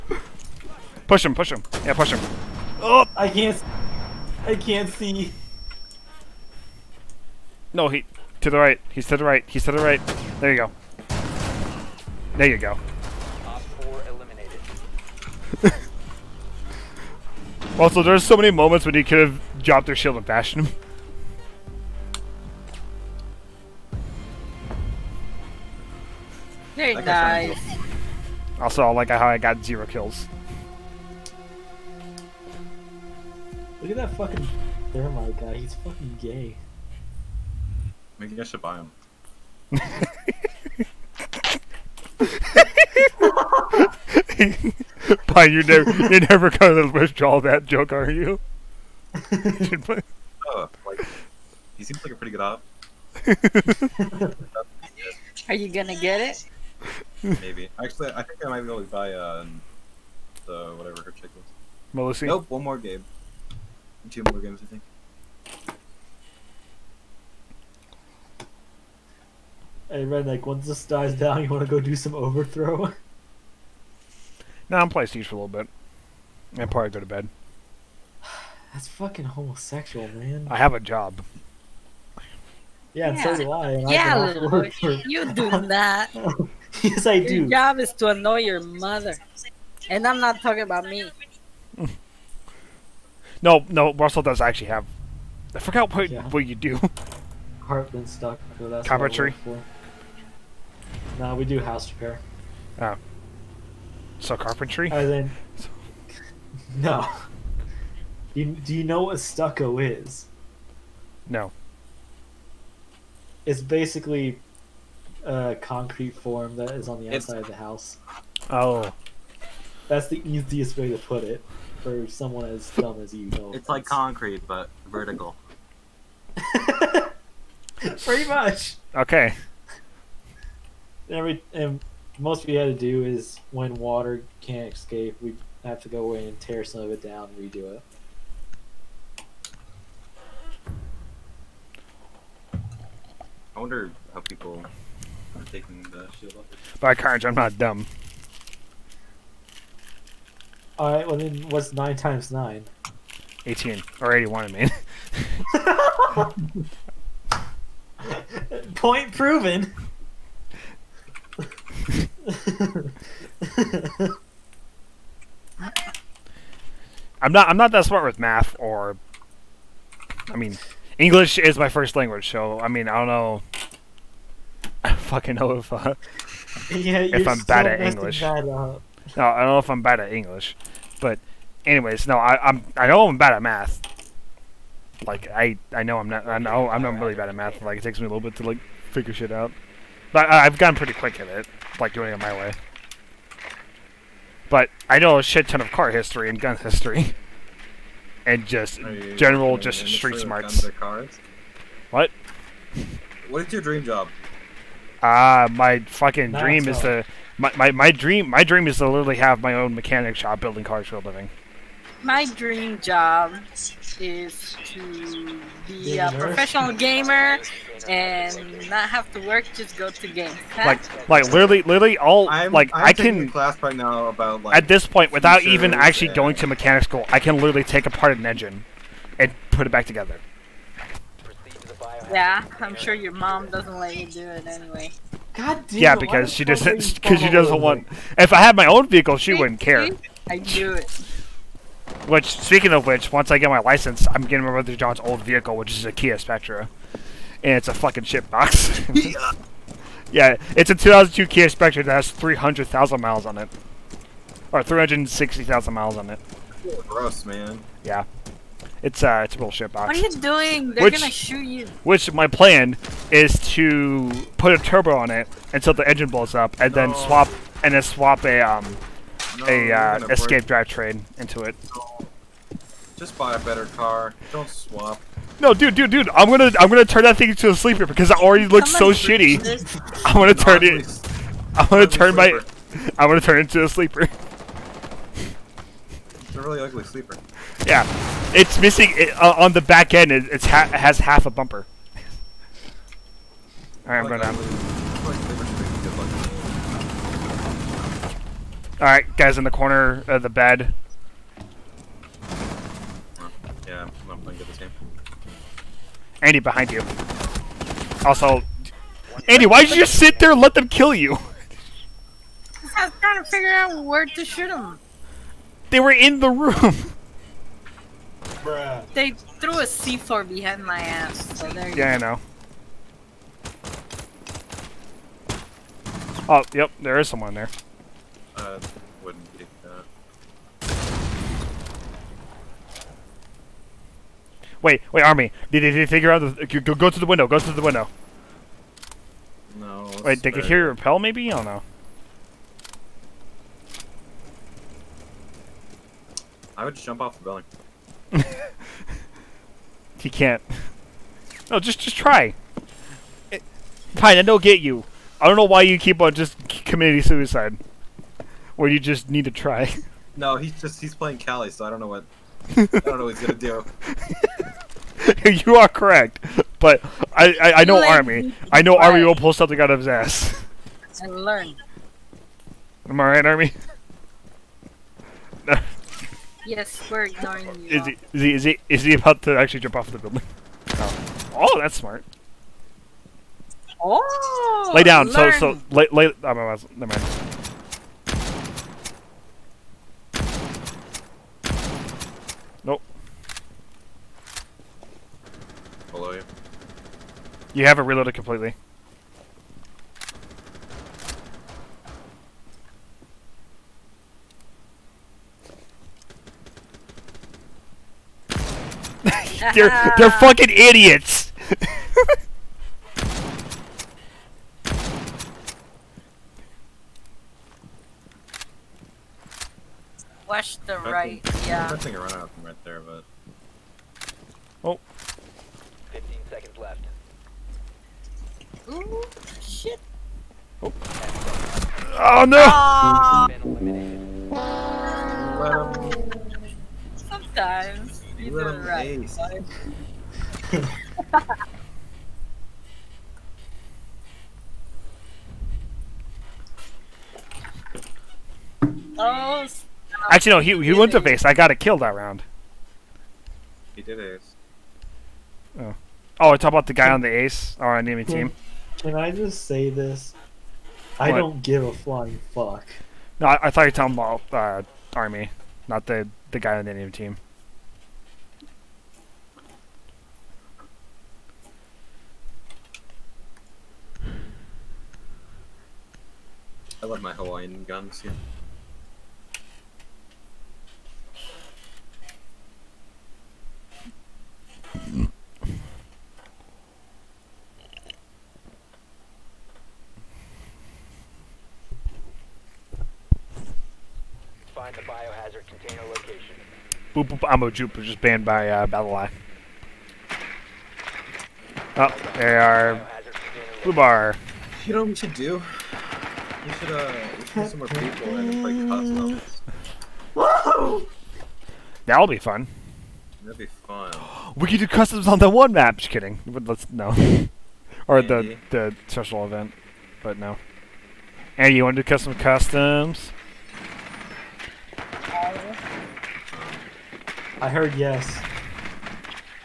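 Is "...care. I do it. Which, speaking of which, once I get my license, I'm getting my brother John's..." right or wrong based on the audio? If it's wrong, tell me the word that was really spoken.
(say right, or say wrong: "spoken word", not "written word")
right.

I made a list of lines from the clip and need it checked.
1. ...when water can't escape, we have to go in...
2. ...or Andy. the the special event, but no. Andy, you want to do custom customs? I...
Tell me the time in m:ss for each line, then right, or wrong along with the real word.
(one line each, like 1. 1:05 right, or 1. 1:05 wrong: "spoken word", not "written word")
1. 2:13 right
2. 8:37 right.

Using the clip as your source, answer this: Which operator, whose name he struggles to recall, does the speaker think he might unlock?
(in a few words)
Melissa.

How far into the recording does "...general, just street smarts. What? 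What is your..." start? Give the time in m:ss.
3:19.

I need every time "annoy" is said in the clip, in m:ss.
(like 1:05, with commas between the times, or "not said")
1:28.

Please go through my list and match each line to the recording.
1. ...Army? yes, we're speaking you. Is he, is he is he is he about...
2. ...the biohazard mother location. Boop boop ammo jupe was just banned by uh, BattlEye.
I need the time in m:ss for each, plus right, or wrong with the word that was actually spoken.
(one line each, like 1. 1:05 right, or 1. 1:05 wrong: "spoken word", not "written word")
1. 6:13 wrong: "ignoring", not "speaking"
2. 8:14 wrong: "container", not "mother".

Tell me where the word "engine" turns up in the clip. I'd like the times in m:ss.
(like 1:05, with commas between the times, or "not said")
3:48, 4:25.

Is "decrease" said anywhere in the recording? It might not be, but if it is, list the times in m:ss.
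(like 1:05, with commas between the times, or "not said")
not said.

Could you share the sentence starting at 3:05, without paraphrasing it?
Like I I know I'm not I know I'm not really bad at math.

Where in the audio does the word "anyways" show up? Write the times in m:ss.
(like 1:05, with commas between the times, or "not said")
3:01, 3:54.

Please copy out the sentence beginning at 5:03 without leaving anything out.
Yeah, I'm not playing good this game.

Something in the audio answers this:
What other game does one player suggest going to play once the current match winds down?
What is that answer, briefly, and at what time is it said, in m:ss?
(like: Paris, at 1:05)
overthrow, at 1:12.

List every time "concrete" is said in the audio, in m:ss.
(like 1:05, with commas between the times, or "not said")
1:55, 2:03.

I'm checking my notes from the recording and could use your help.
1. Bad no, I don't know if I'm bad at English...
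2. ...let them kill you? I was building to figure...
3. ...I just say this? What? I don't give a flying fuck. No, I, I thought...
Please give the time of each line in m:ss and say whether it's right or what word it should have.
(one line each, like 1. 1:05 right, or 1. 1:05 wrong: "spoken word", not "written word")
1. 2:58 right
2. 5:10 wrong: "trying", not "building"
3. 7:38 right.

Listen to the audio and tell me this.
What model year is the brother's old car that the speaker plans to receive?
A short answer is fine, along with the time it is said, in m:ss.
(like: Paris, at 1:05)
2002, at 4:10.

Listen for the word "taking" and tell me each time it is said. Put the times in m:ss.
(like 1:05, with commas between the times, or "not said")
2:25.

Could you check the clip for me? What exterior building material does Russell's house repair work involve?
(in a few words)
stucco.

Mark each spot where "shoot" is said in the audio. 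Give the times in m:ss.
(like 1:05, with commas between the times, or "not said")
4:21, 5:14.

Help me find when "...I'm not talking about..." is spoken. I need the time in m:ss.
1:30.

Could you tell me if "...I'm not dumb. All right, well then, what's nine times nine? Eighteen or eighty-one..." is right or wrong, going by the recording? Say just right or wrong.
right.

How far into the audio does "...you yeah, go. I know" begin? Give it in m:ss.
5:21.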